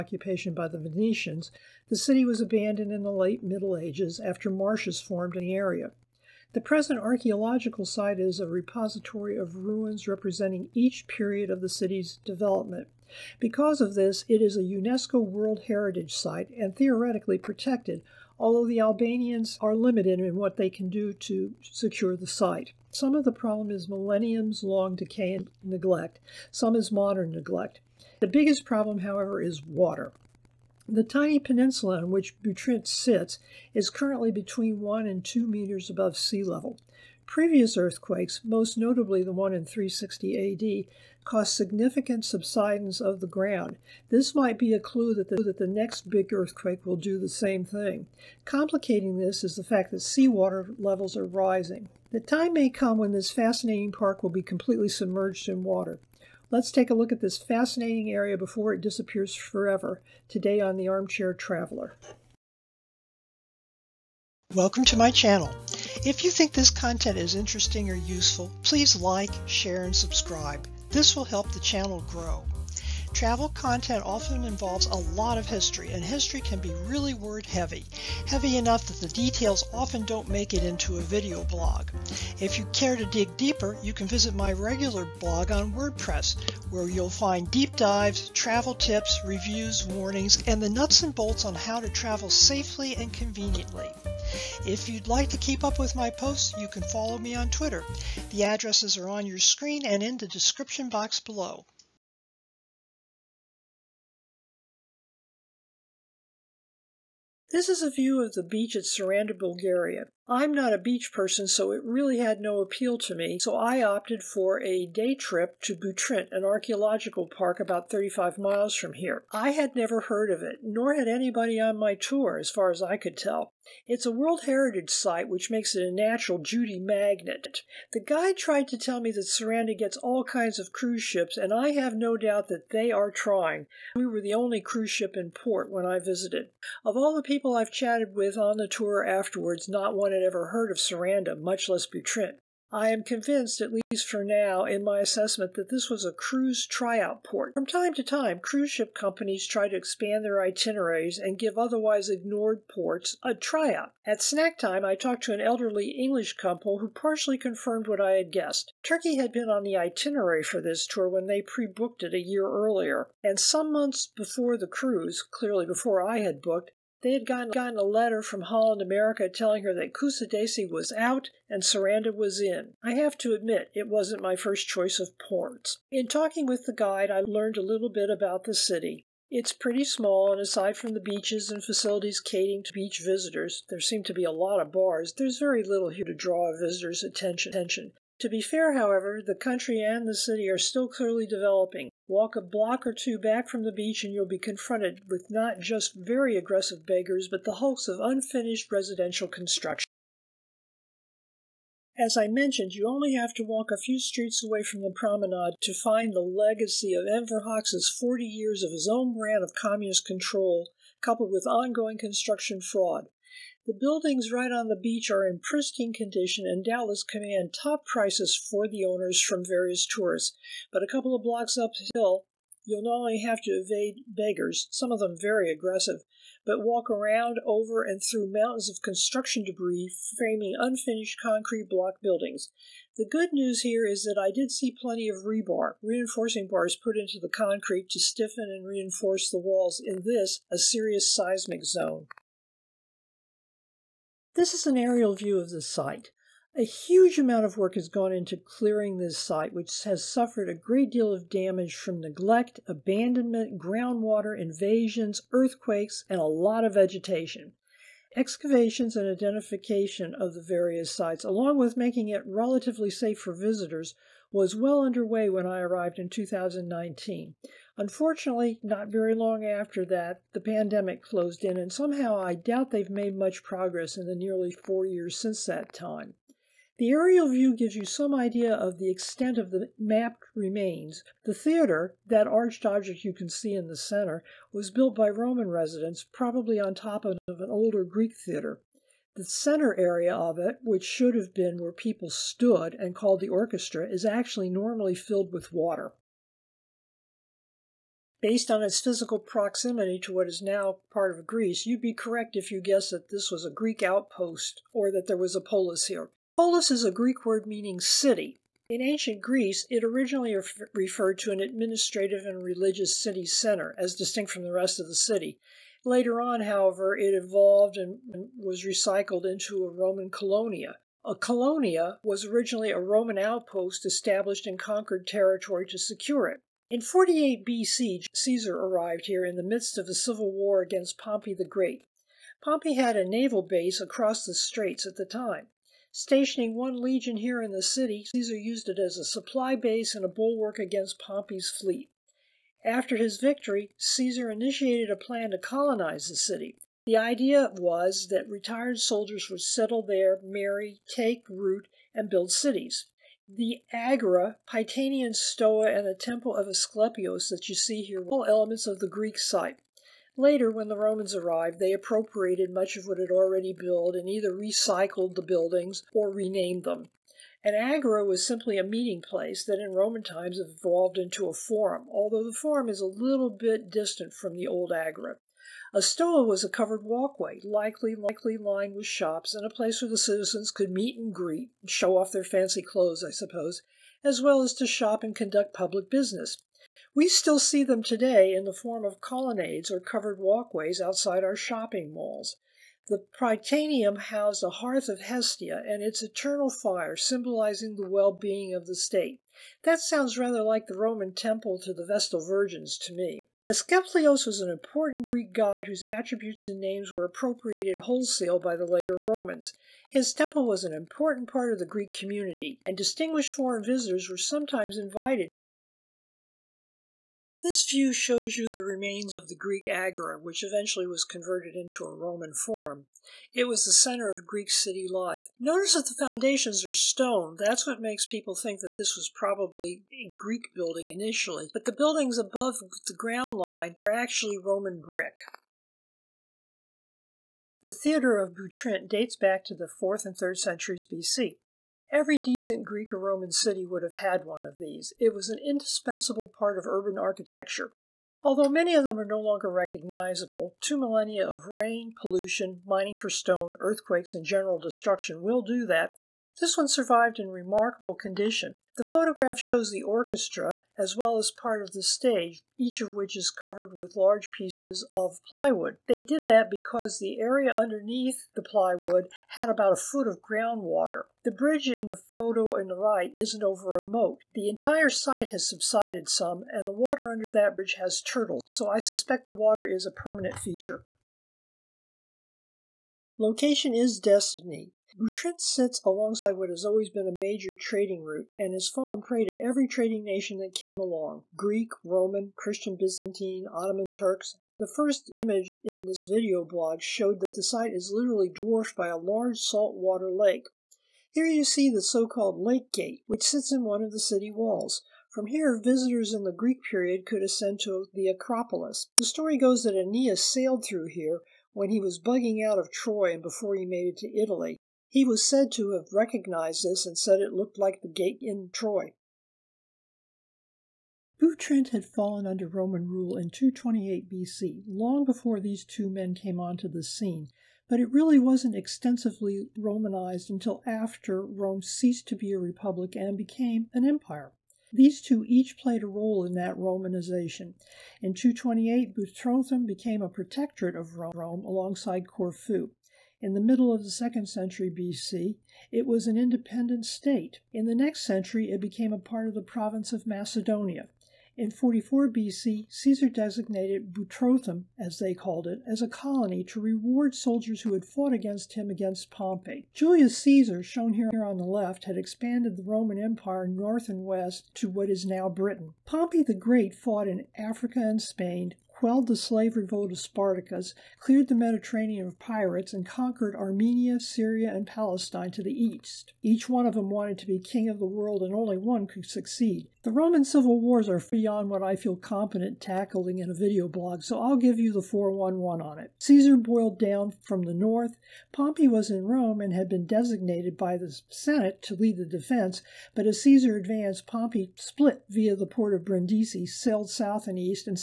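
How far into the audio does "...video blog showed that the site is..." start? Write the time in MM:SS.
08:16.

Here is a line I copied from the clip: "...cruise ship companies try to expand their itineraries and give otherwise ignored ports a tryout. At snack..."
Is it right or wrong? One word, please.
right.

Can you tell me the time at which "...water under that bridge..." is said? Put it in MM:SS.
07:56.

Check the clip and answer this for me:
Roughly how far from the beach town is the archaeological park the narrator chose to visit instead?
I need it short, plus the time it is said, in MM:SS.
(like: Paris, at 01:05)
35 miles, at 01:57.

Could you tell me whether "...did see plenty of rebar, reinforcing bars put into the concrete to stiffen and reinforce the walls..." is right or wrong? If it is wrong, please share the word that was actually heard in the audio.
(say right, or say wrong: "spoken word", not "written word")
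right.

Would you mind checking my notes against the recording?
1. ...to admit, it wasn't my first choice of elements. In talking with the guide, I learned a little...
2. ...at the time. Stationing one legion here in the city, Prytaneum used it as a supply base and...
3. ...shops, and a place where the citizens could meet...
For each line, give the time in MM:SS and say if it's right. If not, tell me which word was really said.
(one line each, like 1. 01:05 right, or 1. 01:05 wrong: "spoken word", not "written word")
1. 02:53 wrong: "ports", not "elements"
2. 05:34 wrong: "Caesar", not "Prytaneum"
3. 06:18 right.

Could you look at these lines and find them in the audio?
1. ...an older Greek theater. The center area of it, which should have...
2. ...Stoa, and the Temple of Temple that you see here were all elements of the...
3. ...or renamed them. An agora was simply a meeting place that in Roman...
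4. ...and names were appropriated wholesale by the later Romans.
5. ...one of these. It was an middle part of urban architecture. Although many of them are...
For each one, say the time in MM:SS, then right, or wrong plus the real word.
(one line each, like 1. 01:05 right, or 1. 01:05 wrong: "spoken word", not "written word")
1. 04:47 right
2. 05:55 wrong: "Asclepios", not "Temple"
3. 06:05 right
4. 06:46 right
5. 07:24 wrong: "indispensable", not "middle".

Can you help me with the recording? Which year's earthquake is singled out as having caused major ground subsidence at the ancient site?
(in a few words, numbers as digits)
360 AD.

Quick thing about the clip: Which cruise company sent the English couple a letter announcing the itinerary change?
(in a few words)
Holland America.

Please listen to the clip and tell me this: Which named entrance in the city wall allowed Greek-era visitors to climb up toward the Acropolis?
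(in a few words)
Lake Gate.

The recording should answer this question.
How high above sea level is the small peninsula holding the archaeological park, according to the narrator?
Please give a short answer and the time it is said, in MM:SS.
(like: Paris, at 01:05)
between 1 and 2 meters, at 00:34.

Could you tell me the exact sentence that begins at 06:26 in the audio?
We still see them today in the form of colonnades or covered walkways outside our shopping malls.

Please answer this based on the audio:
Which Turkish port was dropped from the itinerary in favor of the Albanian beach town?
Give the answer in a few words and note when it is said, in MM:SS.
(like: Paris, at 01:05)
Kusadasi, at 02:49.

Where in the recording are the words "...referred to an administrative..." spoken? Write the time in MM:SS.
05:10.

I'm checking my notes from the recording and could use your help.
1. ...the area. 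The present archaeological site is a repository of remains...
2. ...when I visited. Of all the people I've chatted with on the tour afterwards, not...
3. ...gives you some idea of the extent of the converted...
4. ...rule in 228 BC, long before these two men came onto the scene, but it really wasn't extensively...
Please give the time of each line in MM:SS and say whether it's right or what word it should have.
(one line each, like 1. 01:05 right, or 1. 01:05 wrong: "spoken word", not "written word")
1. 00:05 wrong: "ruins", not "remains"
2. 02:15 right
3. 04:37 wrong: "mapped", not "converted"
4. 08:42 right.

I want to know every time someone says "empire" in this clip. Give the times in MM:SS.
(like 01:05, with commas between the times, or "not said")
08:53, 09:23.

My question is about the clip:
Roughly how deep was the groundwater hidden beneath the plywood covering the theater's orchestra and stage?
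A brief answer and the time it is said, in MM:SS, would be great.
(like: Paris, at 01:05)
a foot, at 07:49.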